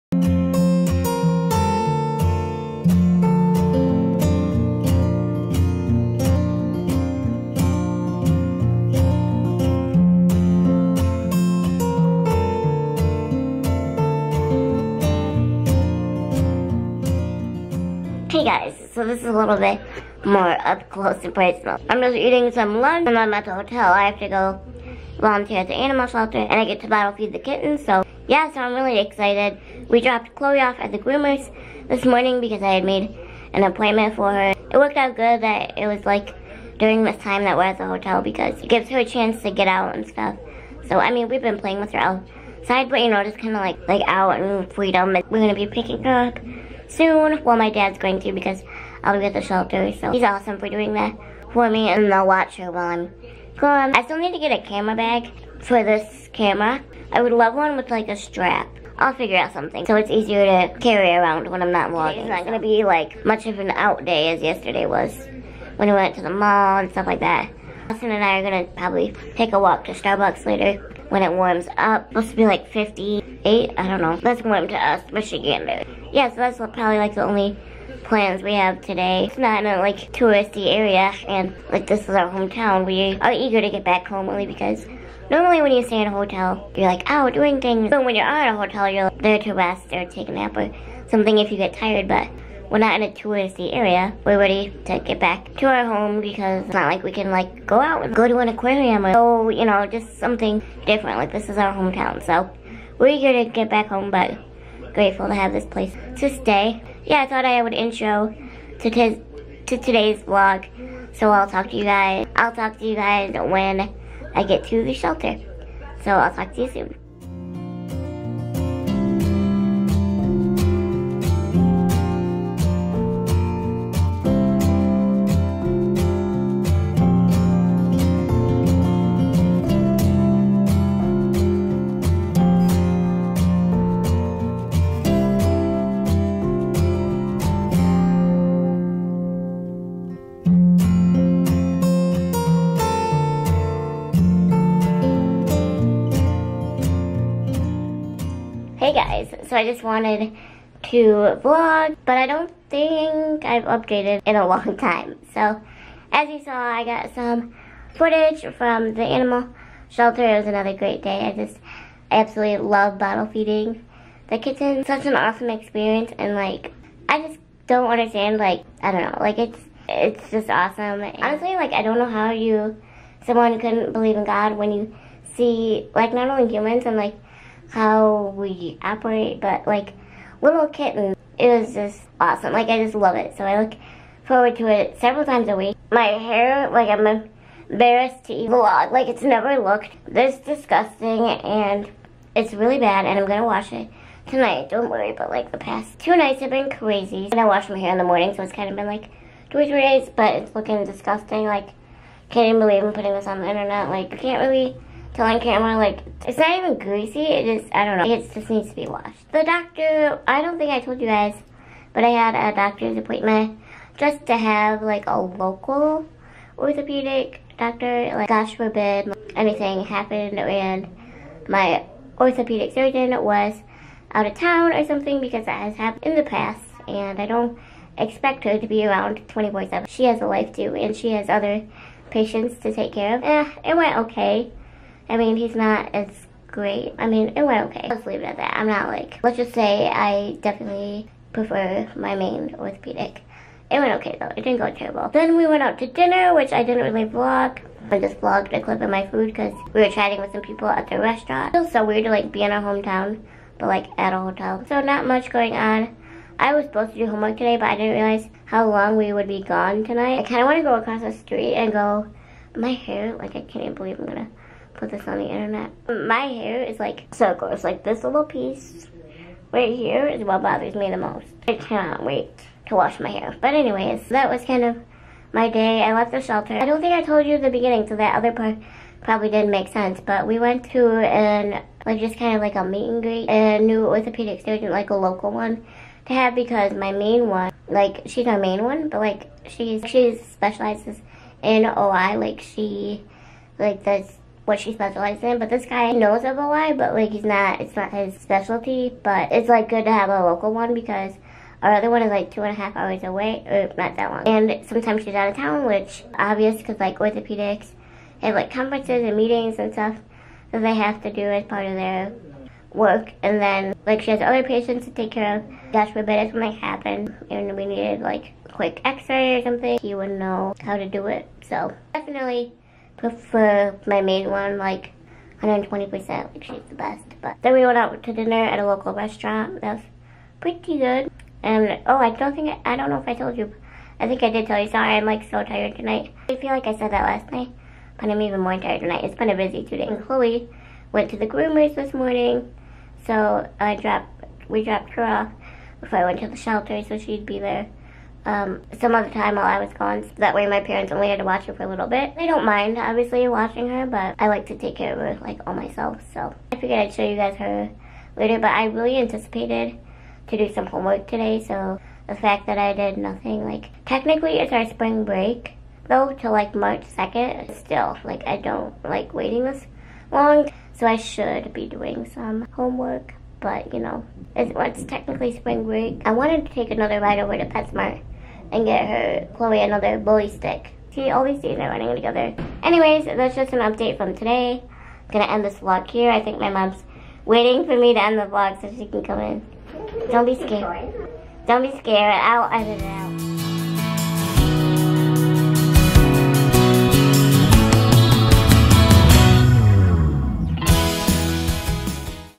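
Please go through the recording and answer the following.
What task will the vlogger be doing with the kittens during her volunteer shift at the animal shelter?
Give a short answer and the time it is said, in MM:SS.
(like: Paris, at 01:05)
Bottle feed, at 00:26.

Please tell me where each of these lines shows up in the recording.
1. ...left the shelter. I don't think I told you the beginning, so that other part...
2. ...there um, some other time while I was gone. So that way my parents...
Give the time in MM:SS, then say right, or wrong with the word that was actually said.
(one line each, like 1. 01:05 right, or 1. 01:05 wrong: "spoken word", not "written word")
1. 04:35 right
2. 05:47 right.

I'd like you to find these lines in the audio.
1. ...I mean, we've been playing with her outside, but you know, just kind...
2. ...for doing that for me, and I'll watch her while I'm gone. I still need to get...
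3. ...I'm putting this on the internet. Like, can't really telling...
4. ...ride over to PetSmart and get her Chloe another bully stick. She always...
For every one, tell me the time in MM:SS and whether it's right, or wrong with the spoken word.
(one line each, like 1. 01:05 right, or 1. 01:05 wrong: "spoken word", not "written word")
1. 00:40 right
2. 00:50 right
3. 03:22 right
4. 06:17 right.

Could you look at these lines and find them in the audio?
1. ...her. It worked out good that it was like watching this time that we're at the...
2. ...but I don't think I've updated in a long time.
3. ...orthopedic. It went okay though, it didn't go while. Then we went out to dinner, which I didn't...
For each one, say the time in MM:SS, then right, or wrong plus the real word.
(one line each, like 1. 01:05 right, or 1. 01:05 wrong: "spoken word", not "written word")
1. 00:34 wrong: "during", not "watching"
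2. 02:32 right
3. 04:02 wrong: "terrible", not "while".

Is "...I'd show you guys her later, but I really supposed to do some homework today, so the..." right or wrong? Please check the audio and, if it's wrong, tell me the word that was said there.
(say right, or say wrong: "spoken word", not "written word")
wrong: "anticipated", not "supposed".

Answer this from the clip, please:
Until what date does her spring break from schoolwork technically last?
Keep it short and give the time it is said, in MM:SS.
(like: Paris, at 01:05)
March 2nd, at 06:06.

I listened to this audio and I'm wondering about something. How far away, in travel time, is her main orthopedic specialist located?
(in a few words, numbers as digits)
Two and a half hours.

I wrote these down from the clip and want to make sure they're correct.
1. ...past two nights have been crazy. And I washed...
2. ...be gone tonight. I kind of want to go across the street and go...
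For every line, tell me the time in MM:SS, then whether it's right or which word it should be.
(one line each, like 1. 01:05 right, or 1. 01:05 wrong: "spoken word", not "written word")
1. 03:15 right
2. 04:19 right.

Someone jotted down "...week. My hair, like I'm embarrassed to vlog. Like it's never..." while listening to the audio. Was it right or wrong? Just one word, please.
right.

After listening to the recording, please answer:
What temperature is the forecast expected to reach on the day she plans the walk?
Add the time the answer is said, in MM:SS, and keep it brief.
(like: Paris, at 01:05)
58, at 01:12.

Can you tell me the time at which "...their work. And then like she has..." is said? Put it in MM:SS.
05:11.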